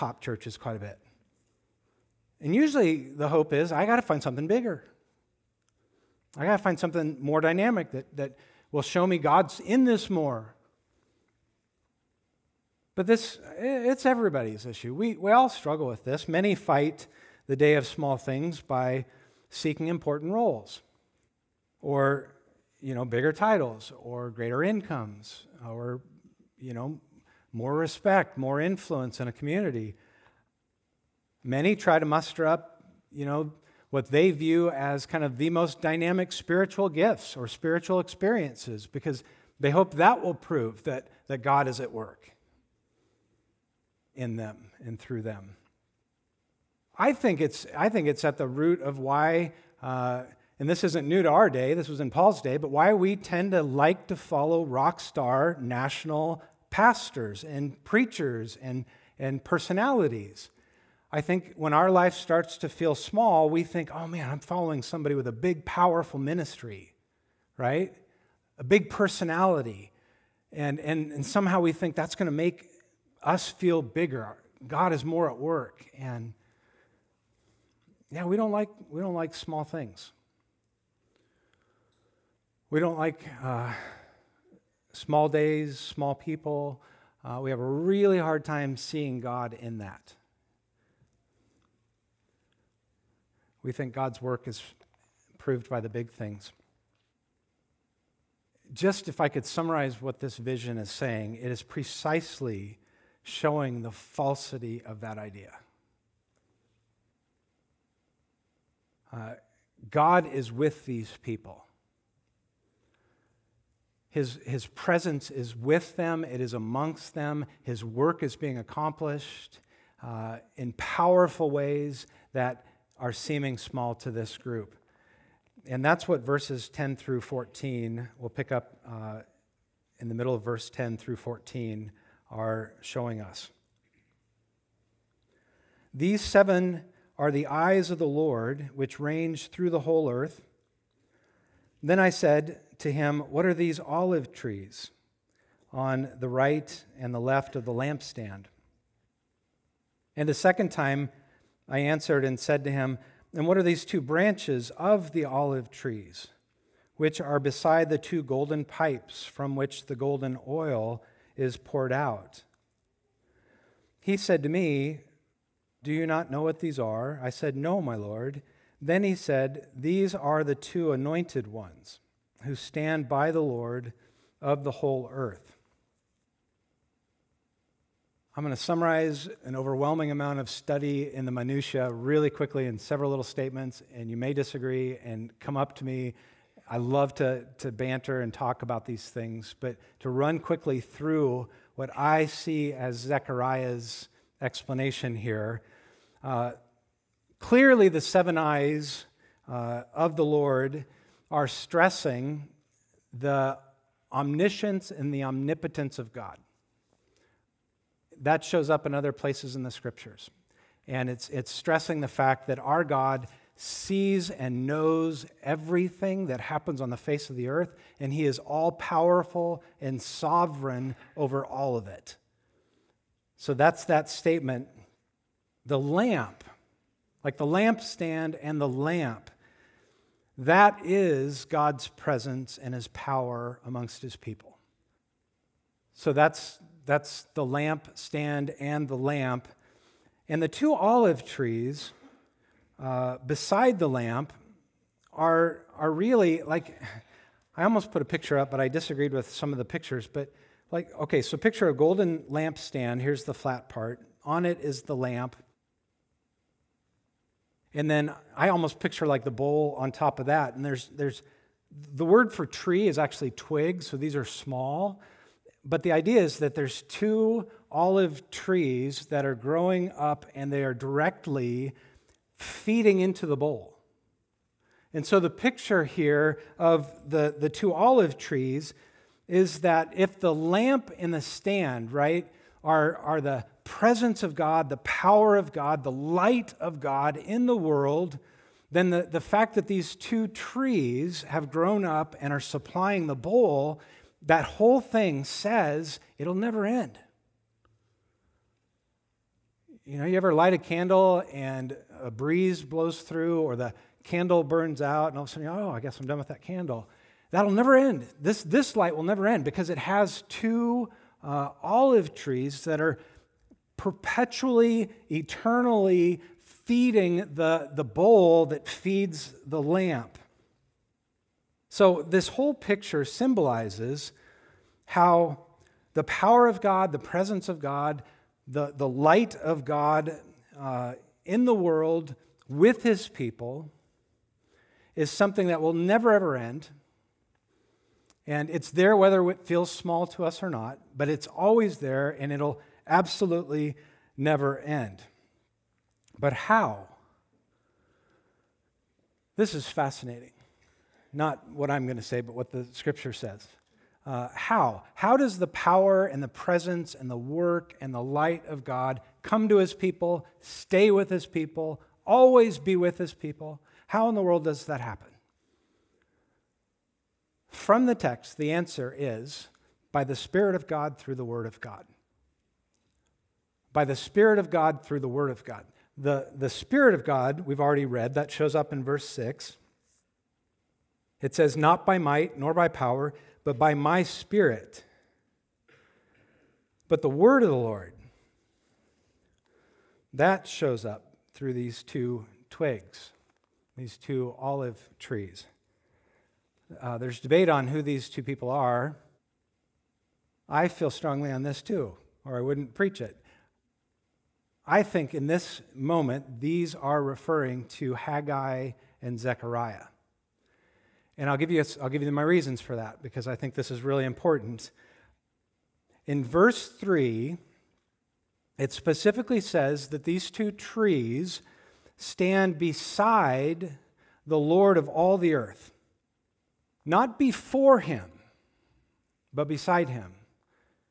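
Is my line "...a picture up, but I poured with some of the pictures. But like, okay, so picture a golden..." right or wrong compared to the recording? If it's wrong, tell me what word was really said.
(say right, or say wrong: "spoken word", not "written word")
wrong: "disagreed", not "poured".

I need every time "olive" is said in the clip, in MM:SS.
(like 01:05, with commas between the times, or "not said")
02:23, 02:35, 04:00, 04:27, 04:37, 05:11, 06:34.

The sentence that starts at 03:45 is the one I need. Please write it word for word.
The lamp, like the lampstand and the lamp, that is God's presence and his power amongst his people.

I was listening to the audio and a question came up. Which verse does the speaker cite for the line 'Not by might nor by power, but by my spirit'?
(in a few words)
Verse 6.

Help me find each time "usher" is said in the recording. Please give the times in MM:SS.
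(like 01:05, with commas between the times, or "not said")
not said.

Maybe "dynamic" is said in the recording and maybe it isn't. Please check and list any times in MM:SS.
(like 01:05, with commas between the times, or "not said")
00:07, 00:35.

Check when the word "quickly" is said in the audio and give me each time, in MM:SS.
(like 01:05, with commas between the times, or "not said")
03:02, 03:10.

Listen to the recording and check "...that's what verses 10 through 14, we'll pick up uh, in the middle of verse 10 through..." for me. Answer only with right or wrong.
right.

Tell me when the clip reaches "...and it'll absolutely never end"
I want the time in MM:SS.
05:42.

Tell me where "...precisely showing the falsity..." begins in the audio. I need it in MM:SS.
01:41.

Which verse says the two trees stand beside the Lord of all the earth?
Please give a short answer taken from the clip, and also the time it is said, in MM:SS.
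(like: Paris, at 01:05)
Verse 3, at 06:56.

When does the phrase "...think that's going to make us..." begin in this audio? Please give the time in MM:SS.
01:11.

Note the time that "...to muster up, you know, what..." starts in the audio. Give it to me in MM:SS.
00:31.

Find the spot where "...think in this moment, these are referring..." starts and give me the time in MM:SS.
06:44.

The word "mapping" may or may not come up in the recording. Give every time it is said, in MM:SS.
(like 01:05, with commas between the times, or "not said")
not said.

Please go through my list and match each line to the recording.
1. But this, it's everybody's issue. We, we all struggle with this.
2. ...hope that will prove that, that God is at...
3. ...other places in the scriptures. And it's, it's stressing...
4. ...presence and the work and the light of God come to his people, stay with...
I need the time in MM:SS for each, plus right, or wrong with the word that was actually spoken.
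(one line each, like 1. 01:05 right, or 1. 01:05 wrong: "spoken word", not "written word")
1. 00:12 right
2. 00:39 right
3. 03:28 right
4. 05:56 right.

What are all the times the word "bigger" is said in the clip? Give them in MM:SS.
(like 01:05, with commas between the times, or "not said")
00:04, 00:23, 01:13.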